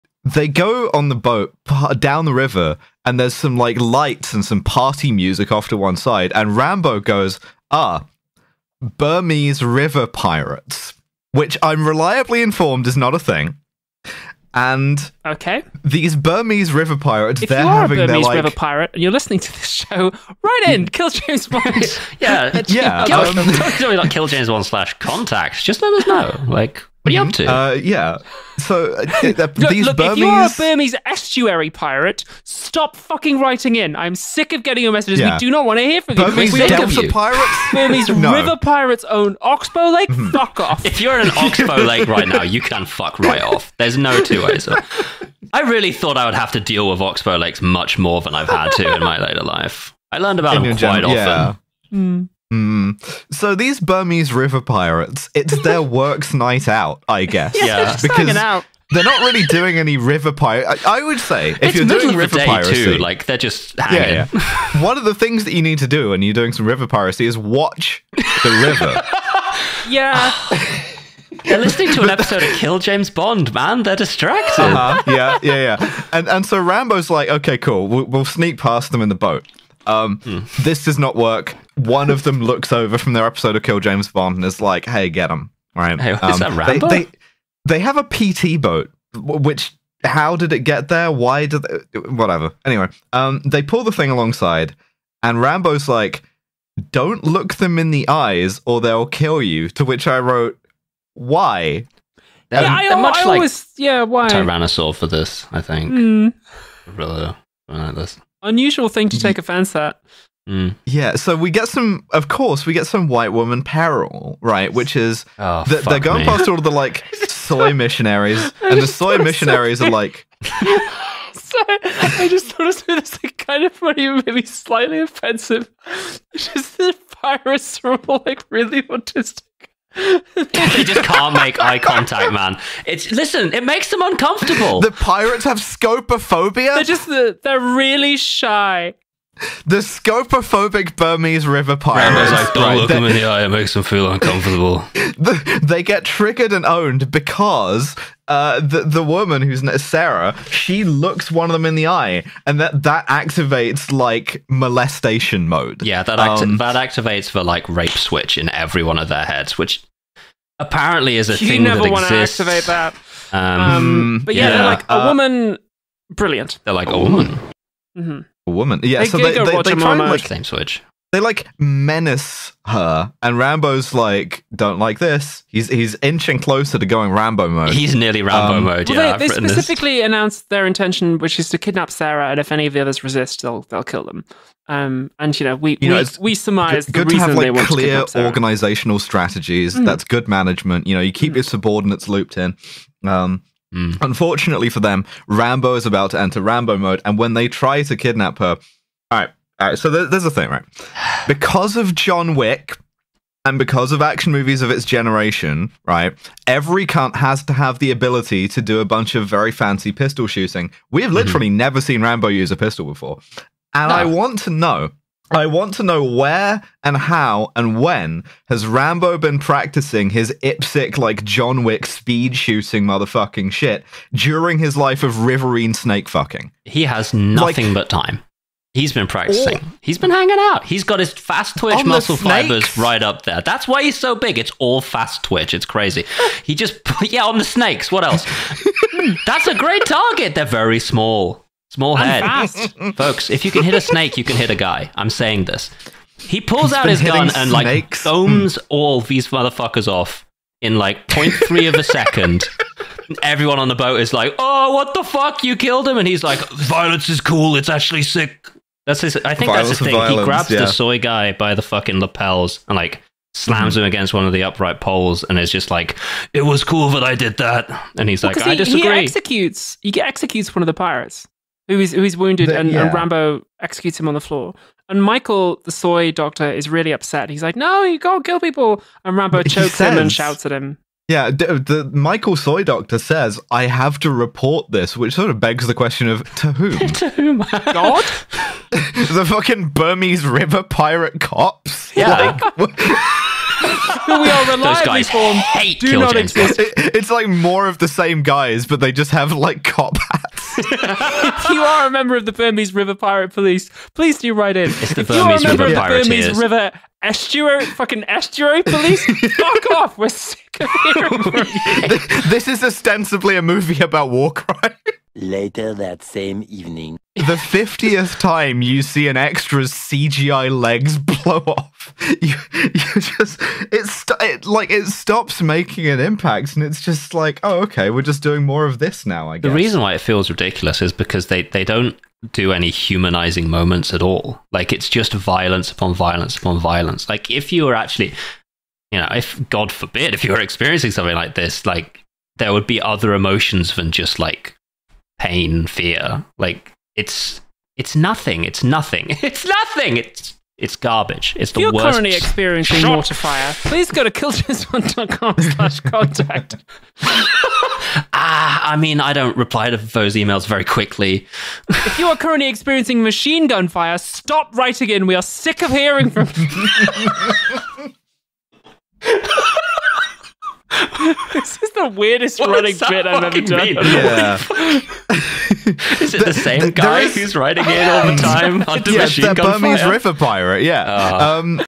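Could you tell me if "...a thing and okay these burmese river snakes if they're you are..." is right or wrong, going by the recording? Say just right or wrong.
wrong.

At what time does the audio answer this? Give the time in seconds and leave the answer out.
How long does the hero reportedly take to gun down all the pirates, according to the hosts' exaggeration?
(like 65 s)
251 s.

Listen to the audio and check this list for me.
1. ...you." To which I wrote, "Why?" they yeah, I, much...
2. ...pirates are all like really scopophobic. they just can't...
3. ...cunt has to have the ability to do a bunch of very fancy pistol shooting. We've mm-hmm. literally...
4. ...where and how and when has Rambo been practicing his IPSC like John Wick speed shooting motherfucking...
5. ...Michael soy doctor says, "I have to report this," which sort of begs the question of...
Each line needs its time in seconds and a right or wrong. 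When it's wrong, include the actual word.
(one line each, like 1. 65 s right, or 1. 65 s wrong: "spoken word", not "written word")
1. 99 s right
2. 127 s wrong: "autistic", not "scopophobic"
3. 206 s right
4. 216 s right
5. 281 s right.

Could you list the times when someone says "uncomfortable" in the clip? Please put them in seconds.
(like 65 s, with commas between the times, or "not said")
134 s, 144 s.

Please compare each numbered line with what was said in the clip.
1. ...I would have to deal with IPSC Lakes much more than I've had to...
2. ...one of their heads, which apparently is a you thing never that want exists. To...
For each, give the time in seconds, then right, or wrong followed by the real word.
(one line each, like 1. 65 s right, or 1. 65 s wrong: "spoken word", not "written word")
1. 46 s wrong: "Oxbow", not "IPSC"
2. 158 s right.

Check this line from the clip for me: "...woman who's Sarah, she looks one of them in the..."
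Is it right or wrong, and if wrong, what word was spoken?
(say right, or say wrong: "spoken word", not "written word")
right.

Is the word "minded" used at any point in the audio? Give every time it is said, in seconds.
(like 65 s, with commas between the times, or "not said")
not said.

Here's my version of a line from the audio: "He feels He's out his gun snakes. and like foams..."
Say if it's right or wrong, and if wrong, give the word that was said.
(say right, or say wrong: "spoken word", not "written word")
wrong: "pulls", not "feels".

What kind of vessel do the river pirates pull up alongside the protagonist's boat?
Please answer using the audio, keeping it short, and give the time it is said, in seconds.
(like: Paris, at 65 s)
PT boat, at 88 s.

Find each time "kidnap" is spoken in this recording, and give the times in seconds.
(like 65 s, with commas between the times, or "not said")
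181 s, 197 s.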